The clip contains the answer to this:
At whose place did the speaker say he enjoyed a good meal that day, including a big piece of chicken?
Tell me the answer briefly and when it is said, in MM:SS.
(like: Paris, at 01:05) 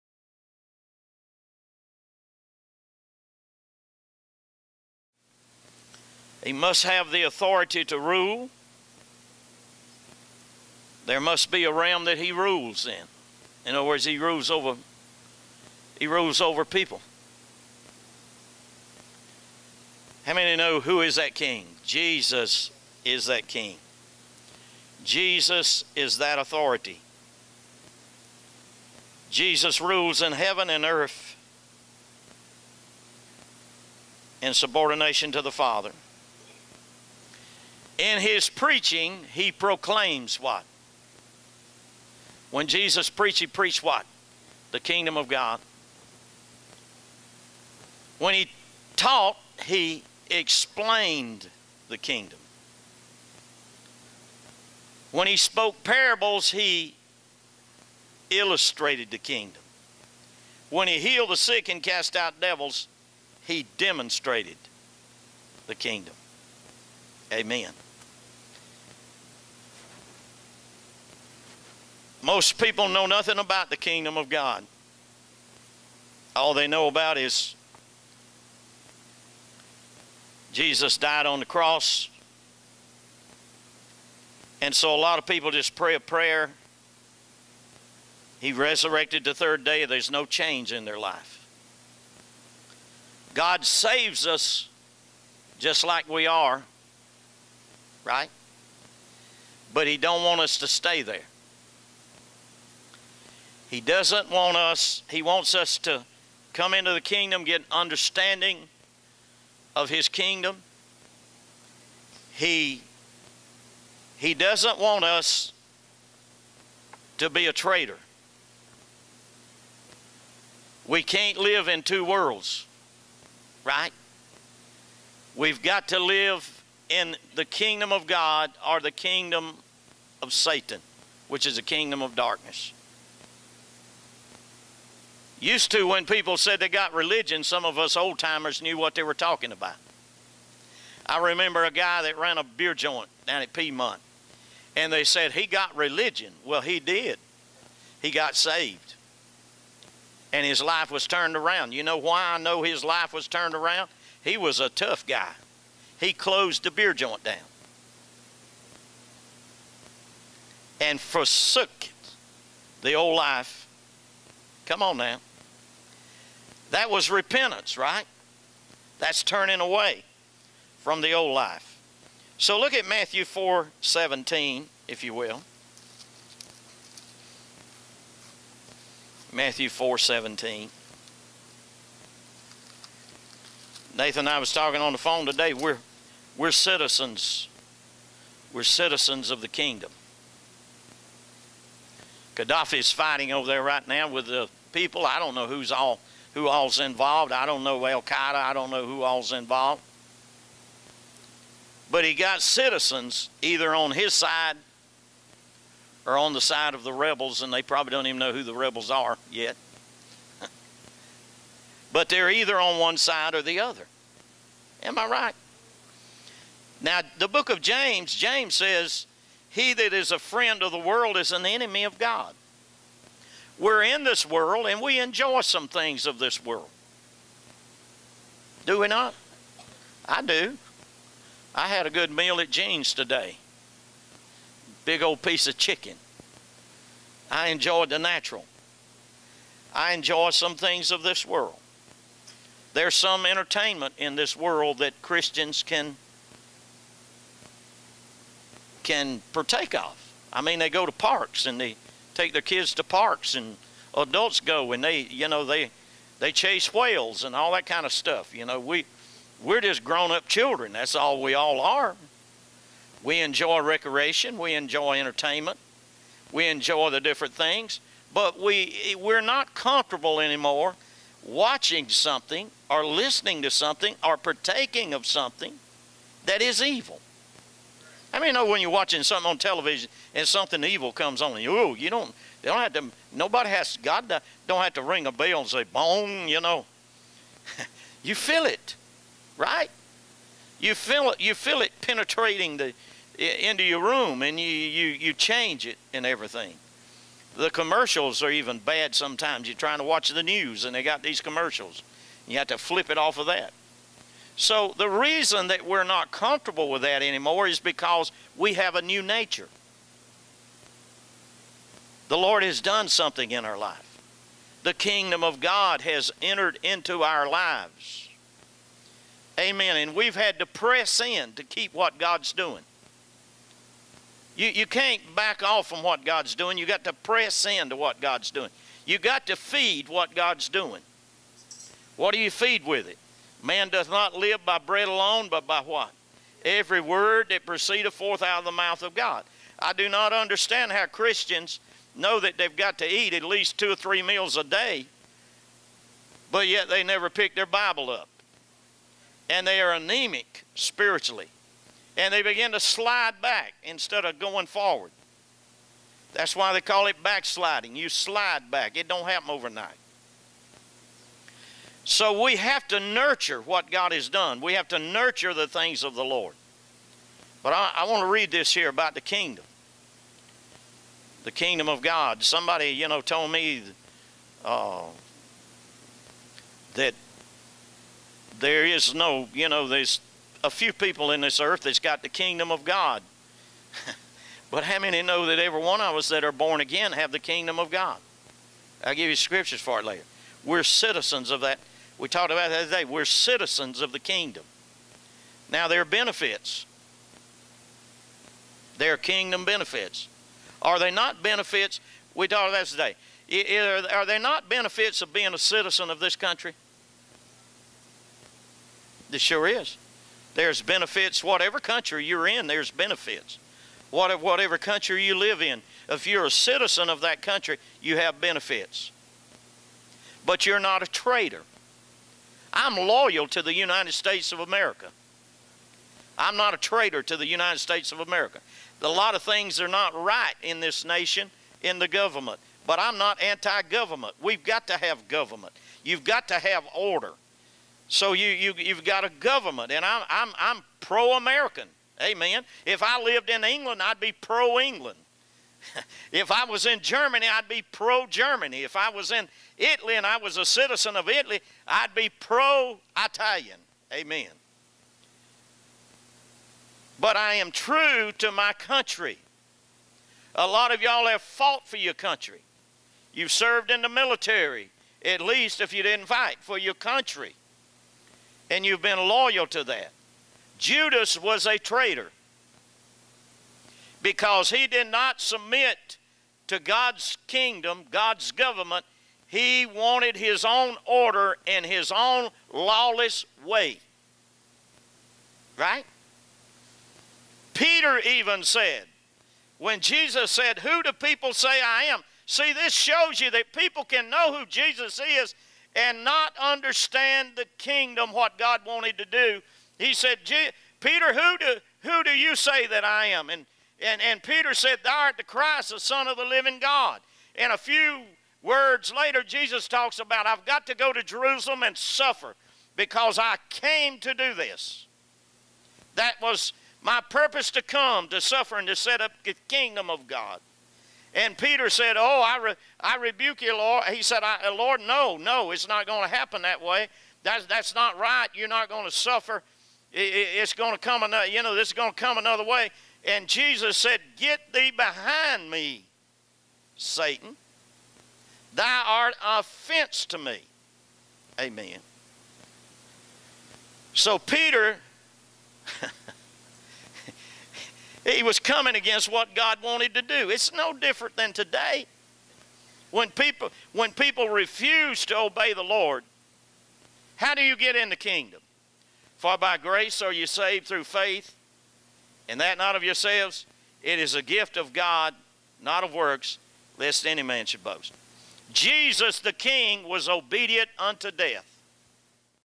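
Jean's, at 03:52.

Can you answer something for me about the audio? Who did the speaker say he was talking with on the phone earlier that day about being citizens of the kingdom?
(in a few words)
Nathan.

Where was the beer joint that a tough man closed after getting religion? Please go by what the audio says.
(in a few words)
Piedmont.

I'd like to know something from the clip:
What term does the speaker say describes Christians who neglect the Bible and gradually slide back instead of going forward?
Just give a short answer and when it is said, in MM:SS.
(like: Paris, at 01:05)
Backsliding, at 05:57.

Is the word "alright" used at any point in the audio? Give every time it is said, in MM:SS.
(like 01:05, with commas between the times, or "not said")
not said.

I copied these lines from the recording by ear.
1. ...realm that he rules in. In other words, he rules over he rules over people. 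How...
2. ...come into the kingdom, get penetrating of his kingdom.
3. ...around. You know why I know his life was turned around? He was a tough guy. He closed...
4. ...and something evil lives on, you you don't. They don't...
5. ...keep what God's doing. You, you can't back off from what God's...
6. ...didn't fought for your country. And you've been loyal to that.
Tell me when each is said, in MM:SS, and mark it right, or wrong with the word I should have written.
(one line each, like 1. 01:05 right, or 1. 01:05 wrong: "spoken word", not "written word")
1. 00:11 right
2. 01:46 wrong: "understanding", not "penetrating"
3. 02:31 right
4. 04:40 wrong: "comes", not "lives"
5. 05:21 right
6. 07:45 wrong: "fight", not "fought".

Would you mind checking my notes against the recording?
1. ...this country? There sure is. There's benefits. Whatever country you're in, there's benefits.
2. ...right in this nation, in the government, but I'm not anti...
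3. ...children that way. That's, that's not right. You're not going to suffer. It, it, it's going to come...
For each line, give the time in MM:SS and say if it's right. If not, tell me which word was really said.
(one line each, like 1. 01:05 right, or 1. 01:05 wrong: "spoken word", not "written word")
1. 06:45 right
2. 07:09 right
3. 08:46 wrong: "happen", not "children".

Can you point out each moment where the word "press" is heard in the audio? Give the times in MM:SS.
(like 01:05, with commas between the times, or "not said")
05:20, 05:26.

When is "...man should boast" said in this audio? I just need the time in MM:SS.
09:27.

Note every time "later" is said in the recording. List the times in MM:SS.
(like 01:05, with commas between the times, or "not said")
06:29, 08:28.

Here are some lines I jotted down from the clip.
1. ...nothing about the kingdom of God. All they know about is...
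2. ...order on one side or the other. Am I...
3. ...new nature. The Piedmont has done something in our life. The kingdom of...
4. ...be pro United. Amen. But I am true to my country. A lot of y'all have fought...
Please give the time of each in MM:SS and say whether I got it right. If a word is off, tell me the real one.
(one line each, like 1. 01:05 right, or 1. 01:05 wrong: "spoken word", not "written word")
1. 01:13 right
2. 03:32 wrong: "either", not "order"
3. 05:08 wrong: "Lord", not "Piedmont"
4. 07:31 wrong: "Italian", not "United".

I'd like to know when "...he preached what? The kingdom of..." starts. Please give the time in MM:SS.
00:43.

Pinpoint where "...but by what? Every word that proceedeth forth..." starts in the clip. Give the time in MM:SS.
05:35.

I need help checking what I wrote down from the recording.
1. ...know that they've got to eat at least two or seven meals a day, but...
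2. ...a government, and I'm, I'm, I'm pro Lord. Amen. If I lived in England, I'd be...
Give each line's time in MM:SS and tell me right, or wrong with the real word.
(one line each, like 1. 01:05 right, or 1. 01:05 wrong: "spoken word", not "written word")
1. 05:41 wrong: "three", not "seven"
2. 07:19 wrong: "American", not "Lord".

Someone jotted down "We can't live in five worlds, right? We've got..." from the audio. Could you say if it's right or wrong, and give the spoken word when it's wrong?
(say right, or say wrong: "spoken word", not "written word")
wrong: "two", not "five".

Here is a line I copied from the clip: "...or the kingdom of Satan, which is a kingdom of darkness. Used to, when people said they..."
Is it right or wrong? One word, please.
right.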